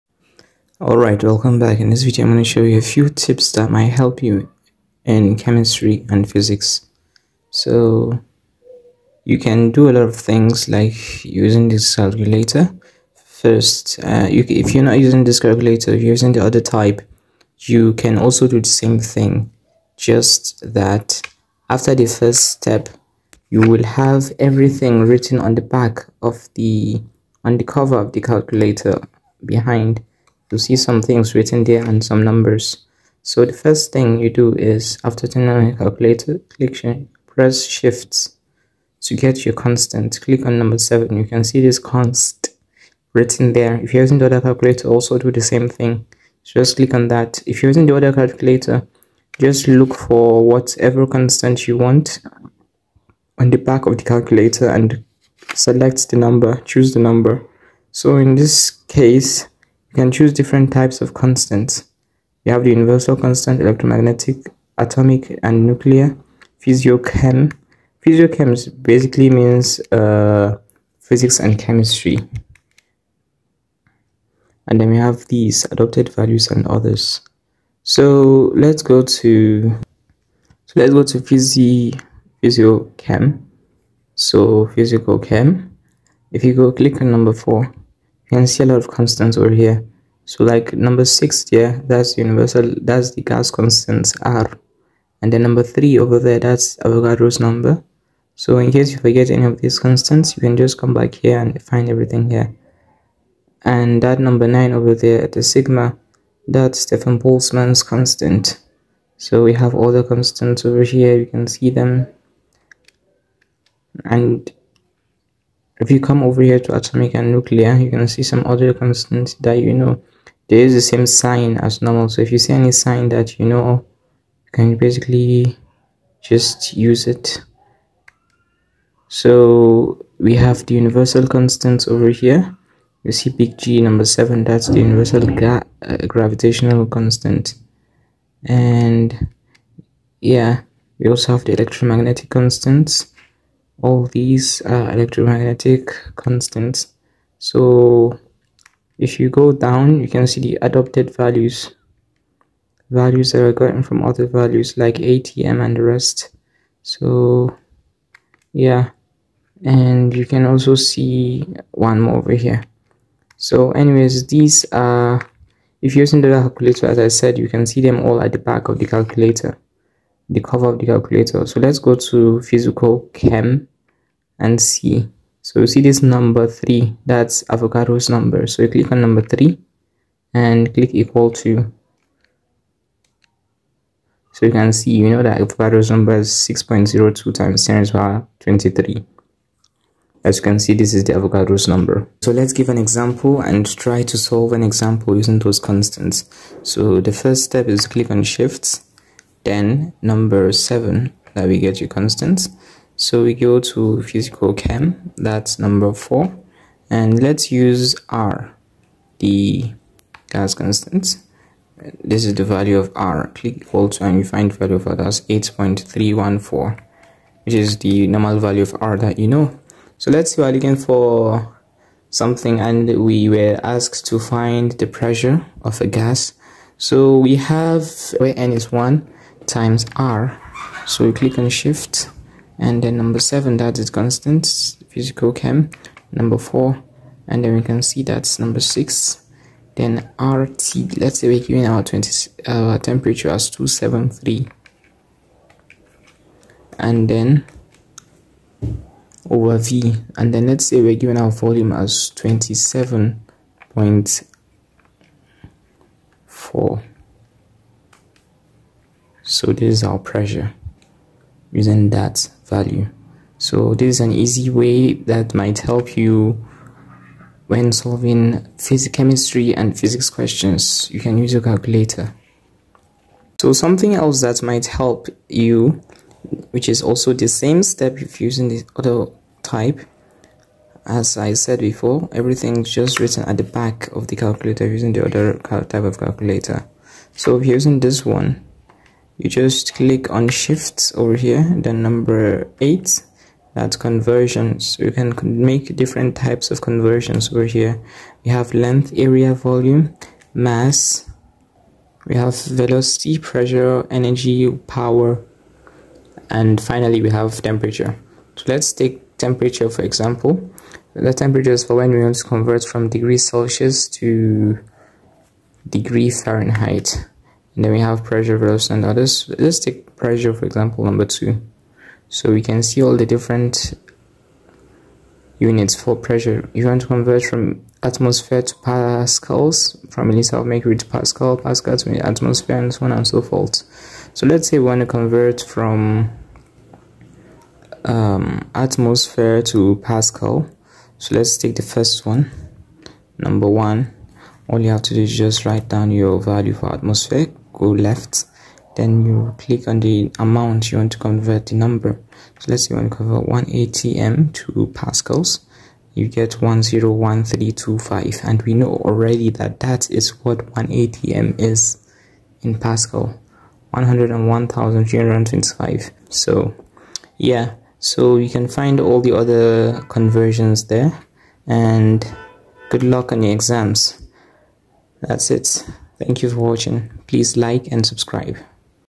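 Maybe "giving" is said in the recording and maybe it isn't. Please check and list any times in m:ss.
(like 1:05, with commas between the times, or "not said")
4:01, 4:10.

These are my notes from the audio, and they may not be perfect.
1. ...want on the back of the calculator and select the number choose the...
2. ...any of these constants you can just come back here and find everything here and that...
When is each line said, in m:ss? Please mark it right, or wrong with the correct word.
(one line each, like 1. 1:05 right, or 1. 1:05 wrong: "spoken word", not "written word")
1. 0:51 right
2. 1:39 right.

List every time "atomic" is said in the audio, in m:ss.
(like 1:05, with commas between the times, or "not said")
1:04, 1:56.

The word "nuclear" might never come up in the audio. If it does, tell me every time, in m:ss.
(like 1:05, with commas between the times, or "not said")
1:05, 1:57.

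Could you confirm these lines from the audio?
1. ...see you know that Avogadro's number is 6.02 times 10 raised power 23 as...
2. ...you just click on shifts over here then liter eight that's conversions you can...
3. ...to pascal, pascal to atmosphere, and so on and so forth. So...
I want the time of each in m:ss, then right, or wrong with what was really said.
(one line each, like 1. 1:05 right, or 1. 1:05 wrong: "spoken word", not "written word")
1. 3:04 right
2. 4:49 wrong: "number", not "liter"
3. 5:30 right.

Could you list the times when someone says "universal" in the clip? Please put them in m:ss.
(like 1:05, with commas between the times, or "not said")
1:02, 1:32, 2:10, 2:14.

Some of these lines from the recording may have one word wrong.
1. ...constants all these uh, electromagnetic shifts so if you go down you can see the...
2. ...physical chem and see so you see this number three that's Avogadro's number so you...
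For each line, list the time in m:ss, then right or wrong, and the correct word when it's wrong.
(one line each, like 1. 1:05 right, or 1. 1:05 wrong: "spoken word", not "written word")
1. 2:22 wrong: "constants", not "shifts"
2. 2:52 right.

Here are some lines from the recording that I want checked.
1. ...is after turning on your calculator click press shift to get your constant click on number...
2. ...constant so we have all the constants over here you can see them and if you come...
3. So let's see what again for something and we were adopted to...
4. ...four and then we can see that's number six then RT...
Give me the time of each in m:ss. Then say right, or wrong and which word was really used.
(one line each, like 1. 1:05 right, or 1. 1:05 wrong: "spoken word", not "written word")
1. 0:34 right
2. 1:47 right
3. 3:39 wrong: "asked", not "adopted"
4. 3:56 right.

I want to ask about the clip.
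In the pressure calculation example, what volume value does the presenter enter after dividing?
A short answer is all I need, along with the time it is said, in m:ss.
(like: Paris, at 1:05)
27.4, at 4:12.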